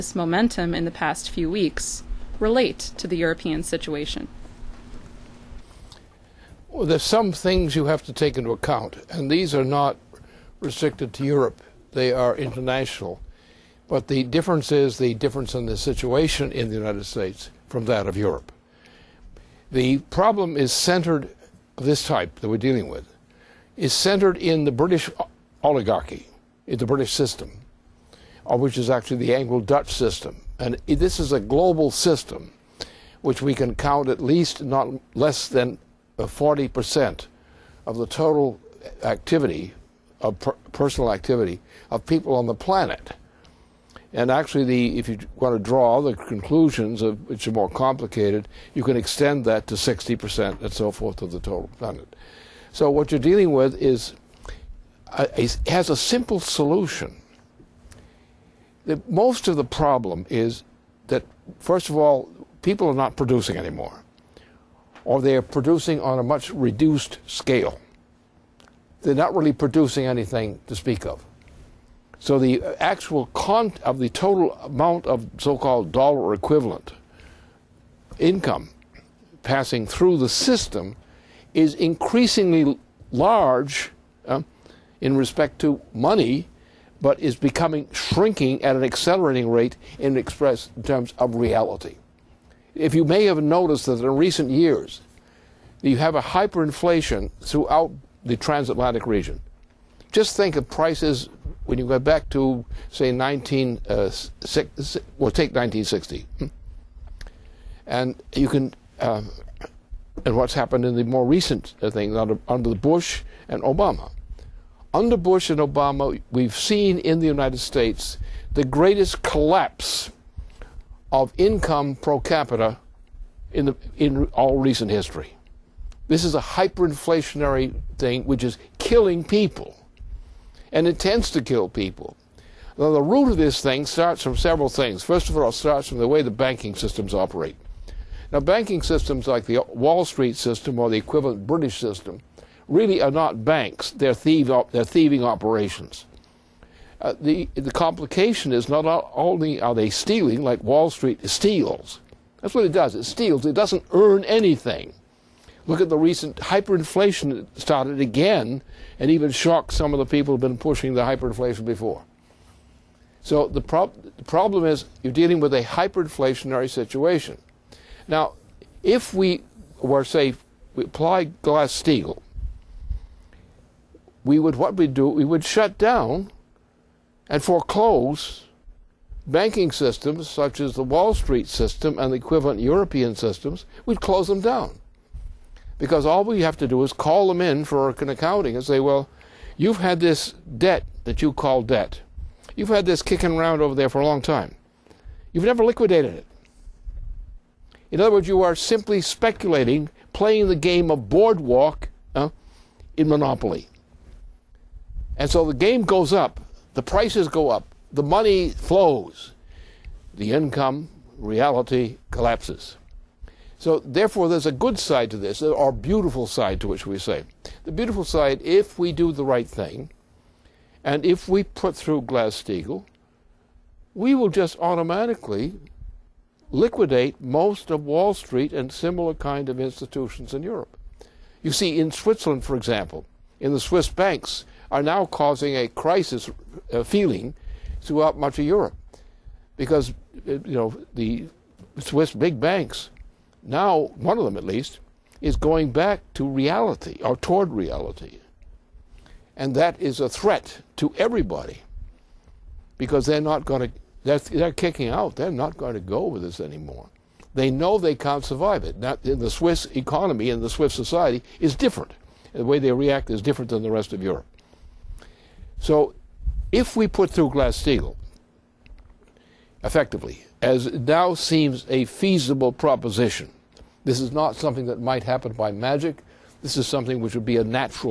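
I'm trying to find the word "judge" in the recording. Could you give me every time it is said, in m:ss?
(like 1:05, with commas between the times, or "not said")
not said.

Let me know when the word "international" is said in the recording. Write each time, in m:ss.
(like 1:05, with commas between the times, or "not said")
0:12.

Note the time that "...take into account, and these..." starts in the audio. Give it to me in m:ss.
0:08.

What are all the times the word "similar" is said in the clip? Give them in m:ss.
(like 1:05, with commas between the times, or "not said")
3:48.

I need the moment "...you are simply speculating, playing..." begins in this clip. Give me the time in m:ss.
3:18.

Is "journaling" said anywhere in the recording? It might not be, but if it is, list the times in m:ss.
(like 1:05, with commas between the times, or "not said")
not said.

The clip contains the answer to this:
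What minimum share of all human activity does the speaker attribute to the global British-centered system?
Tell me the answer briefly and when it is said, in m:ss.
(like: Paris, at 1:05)
40%, at 0:36.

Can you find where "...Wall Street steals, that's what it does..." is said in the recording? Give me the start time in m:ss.
2:30.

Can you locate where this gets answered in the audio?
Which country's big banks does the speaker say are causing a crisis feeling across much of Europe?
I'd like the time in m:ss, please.
3:51.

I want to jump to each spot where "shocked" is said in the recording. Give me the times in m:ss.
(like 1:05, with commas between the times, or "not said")
2:39.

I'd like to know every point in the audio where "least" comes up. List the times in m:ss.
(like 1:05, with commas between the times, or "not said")
0:34, 4:04.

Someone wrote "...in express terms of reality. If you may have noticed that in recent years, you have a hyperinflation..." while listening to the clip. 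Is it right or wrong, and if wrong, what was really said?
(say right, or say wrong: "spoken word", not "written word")
right.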